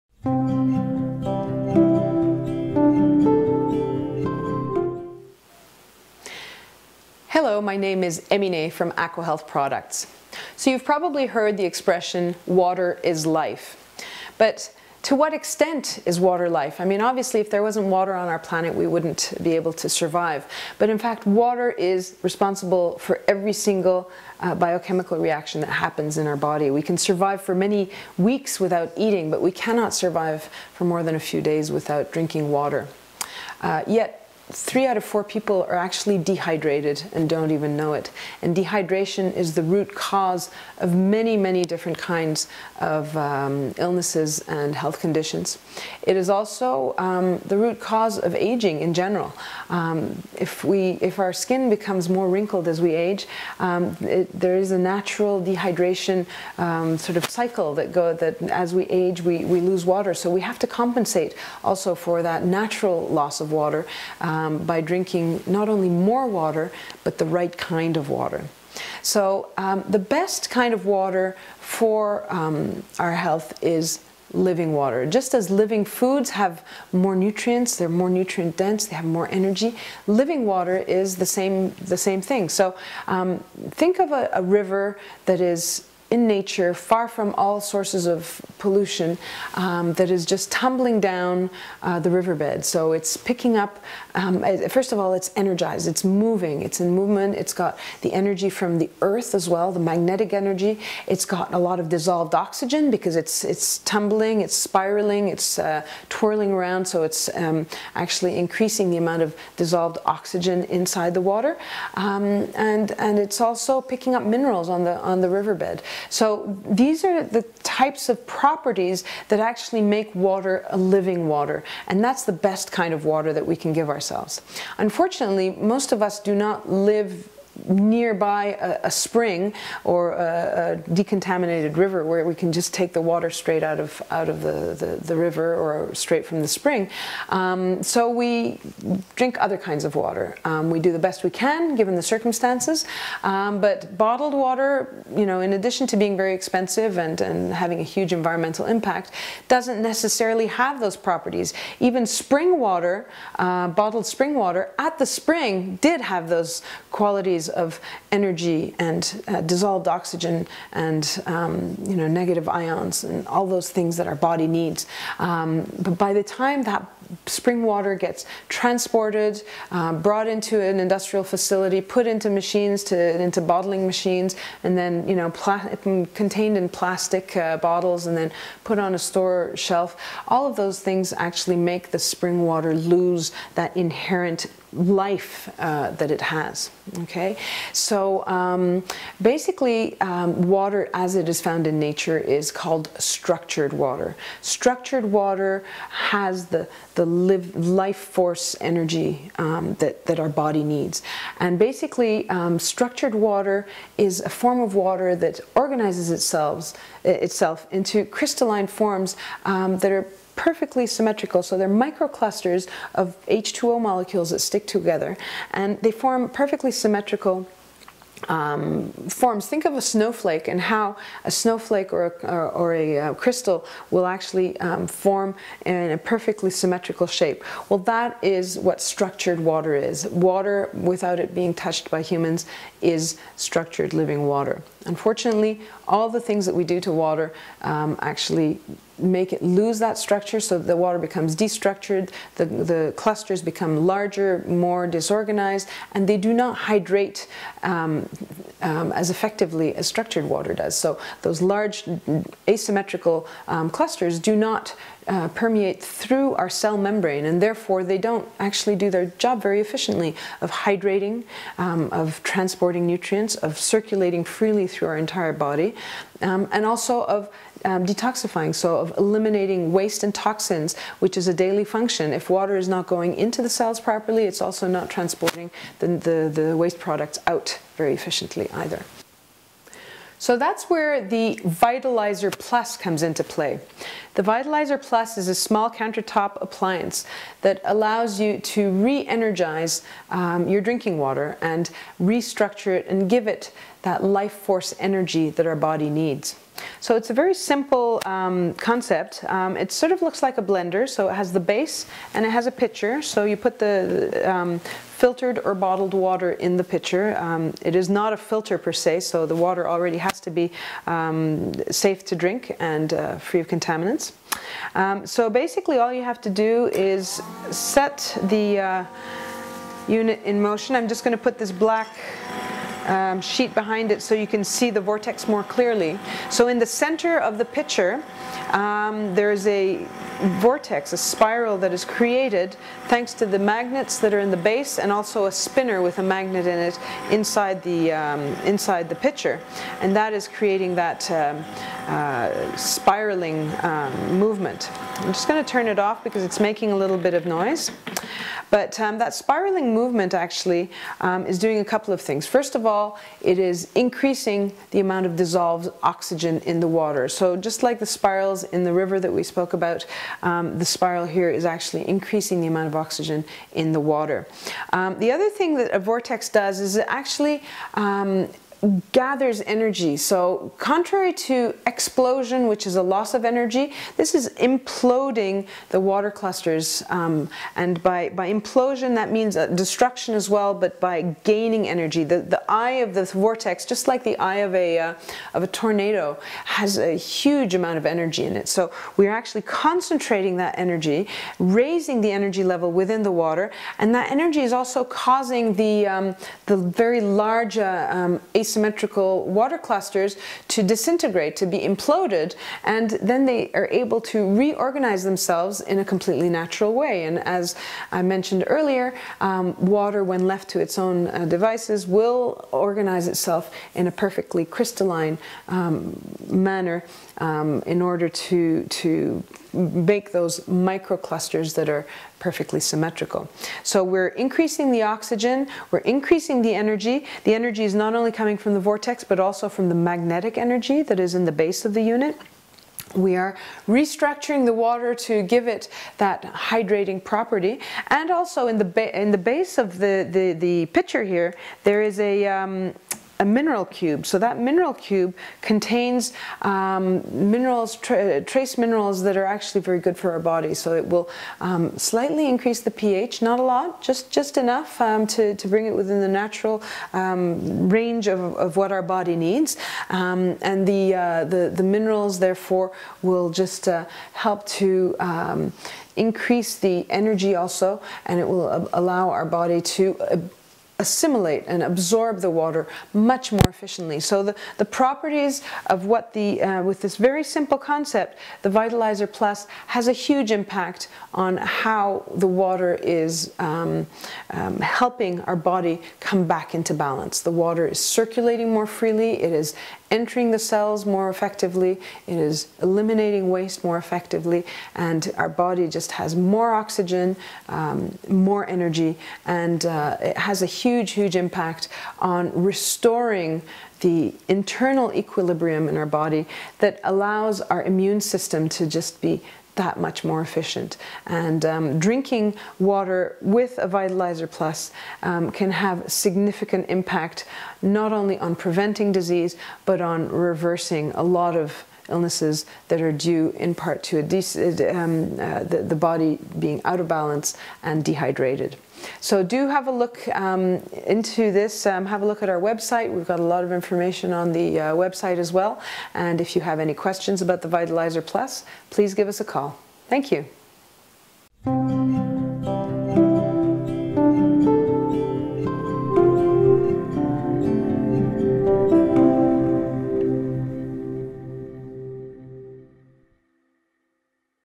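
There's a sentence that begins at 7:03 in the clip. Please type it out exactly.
So we're increasing the oxygen, we're increasing the energy.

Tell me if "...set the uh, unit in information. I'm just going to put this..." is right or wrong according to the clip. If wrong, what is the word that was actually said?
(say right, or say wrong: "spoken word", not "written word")
wrong: "motion", not "information".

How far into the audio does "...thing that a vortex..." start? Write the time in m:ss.
6:05.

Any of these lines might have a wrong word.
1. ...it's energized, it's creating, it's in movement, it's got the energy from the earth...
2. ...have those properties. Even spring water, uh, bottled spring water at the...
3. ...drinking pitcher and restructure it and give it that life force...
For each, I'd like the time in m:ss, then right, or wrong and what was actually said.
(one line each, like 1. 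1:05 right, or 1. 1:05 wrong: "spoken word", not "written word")
1. 1:35 wrong: "moving", not "creating"
2. 2:30 right
3. 4:50 wrong: "water", not "pitcher".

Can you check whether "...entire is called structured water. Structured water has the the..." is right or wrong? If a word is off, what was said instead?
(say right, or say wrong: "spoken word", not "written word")
wrong: "nature", not "entire".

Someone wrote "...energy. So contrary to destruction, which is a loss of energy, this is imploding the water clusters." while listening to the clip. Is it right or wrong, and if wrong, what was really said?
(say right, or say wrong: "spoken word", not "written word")
wrong: "explosion", not "destruction".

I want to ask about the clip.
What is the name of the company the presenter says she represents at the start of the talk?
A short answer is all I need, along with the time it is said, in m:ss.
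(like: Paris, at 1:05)
AquaHealth Products, at 0:08.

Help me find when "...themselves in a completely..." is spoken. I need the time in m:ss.
6:45.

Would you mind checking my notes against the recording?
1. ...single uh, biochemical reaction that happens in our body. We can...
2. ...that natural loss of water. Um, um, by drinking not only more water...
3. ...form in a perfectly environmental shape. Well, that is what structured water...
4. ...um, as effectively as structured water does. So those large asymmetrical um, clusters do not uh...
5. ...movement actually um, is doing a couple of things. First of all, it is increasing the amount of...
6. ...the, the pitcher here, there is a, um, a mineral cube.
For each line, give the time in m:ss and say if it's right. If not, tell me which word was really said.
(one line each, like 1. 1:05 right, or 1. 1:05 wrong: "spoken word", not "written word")
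1. 0:23 right
2. 1:02 right
3. 3:44 wrong: "symmetrical", not "environmental"
4. 4:08 right
5. 5:49 right
6. 7:20 right.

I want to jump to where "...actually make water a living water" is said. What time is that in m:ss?
1:59.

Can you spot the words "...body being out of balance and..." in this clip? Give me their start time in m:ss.
8:45.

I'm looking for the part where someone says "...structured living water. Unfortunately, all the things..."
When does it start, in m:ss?
3:53.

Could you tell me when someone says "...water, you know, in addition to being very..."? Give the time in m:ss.
2:24.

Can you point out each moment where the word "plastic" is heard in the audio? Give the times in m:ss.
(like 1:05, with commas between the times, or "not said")
2:56.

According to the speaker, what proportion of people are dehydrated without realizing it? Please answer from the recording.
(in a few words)
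three out of four.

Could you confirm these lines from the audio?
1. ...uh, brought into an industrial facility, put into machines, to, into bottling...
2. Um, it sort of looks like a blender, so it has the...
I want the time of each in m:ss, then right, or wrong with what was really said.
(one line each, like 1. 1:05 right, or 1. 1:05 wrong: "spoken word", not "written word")
1. 2:49 right
2. 4:59 right.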